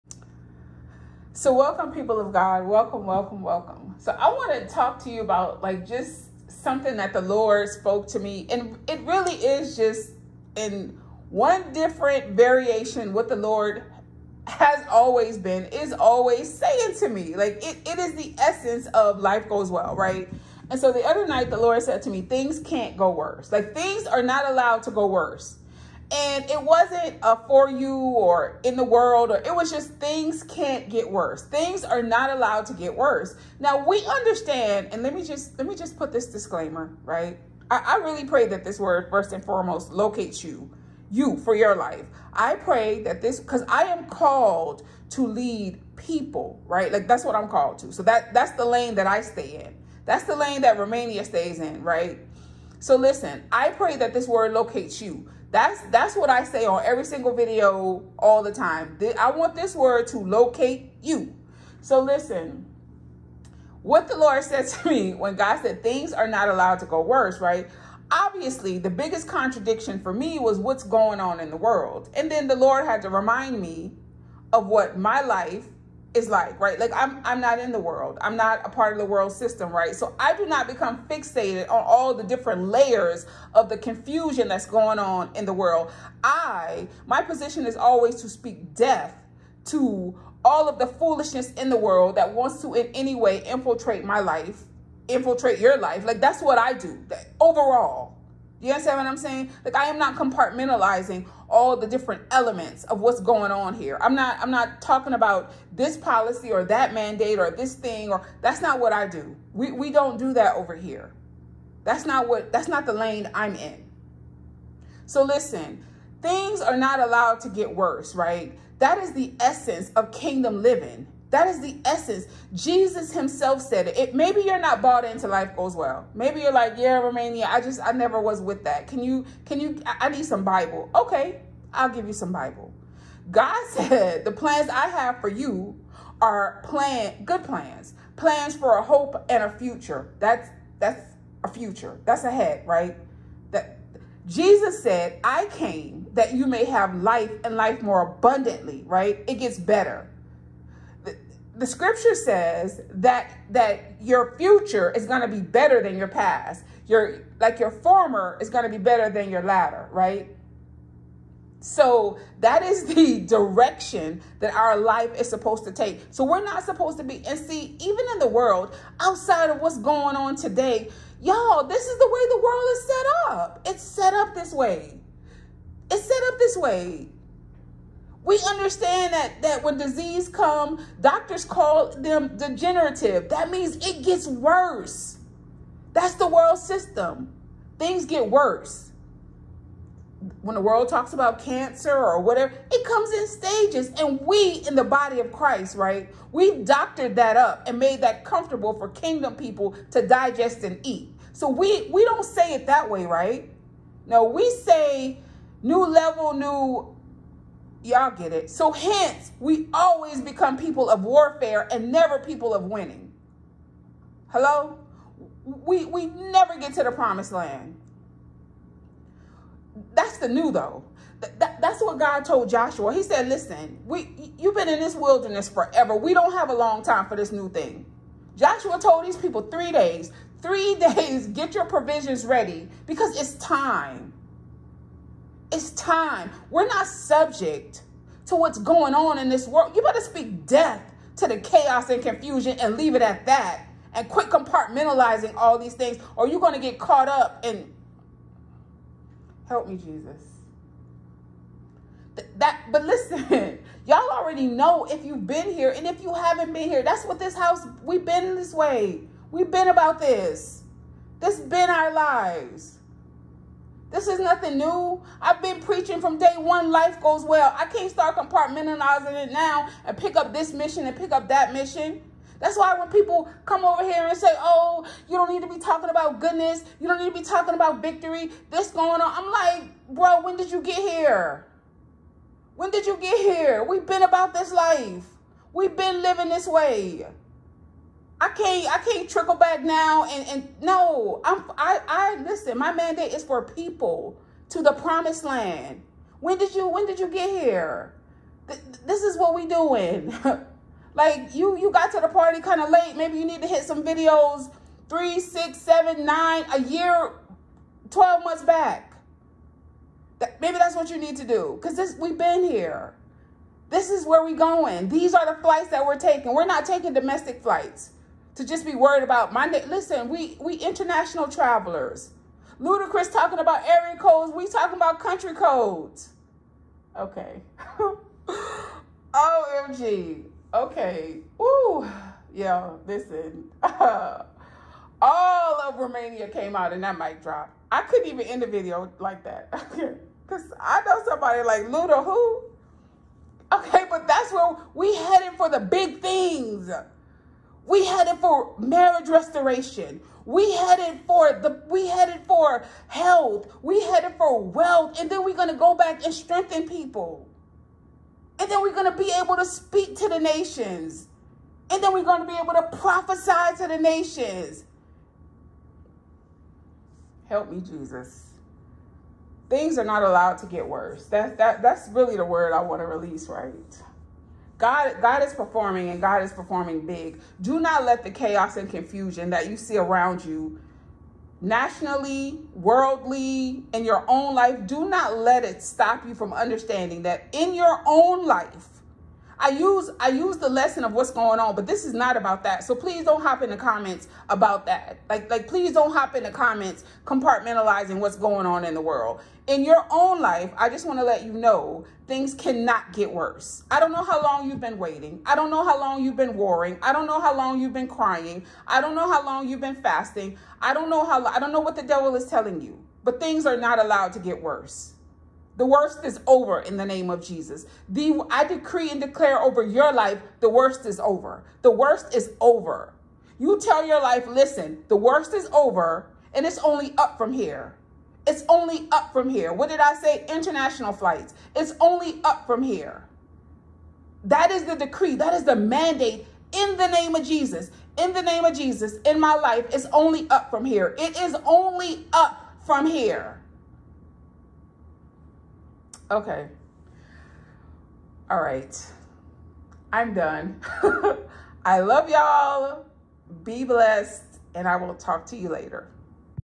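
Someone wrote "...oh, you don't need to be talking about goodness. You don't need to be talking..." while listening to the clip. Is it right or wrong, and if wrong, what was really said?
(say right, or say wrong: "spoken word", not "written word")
right.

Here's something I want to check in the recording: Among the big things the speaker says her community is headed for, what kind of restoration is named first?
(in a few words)
marriage restoration.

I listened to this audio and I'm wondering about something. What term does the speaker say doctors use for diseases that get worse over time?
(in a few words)
degenerative.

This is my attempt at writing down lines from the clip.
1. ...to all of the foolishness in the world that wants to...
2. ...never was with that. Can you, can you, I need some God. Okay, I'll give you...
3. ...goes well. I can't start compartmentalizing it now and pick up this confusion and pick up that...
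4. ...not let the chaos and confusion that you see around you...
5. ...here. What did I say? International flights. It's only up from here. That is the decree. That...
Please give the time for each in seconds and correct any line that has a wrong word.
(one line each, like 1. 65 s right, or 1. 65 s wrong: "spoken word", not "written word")
1. 89 s right
2. 127 s wrong: "Bible", not "God"
3. 267 s wrong: "mission", not "confusion"
4. 377 s right
5. 429 s right.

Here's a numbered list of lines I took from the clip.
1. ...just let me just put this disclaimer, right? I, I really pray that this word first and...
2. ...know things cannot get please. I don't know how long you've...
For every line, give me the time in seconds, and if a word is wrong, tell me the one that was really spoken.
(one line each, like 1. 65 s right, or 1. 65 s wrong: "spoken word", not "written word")
1. 35 s right
2. 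401 s wrong: "worse", not "please".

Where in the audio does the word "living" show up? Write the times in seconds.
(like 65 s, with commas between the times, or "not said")
120 s, 286 s.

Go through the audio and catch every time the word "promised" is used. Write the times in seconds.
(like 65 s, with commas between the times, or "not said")
216 s, 294 s.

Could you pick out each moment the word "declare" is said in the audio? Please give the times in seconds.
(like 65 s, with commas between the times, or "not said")
418 s.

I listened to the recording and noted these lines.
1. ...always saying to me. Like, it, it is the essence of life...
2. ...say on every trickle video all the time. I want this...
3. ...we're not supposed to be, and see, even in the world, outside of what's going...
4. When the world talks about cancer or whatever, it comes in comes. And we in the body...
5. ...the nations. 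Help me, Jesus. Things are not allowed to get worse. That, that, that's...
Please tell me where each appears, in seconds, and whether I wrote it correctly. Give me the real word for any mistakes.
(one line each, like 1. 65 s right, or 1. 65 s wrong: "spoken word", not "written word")
1. 15 s right
2. 56 s wrong: "single", not "trickle"
3. 166 s right
4. 190 s wrong: "stages", not "comes"
5. 363 s right.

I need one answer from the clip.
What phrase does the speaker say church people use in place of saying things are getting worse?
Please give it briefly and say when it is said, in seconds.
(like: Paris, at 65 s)
new level, at 205 s.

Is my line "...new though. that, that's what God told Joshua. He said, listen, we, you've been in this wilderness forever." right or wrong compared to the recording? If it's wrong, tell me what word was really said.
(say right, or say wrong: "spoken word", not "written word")
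right.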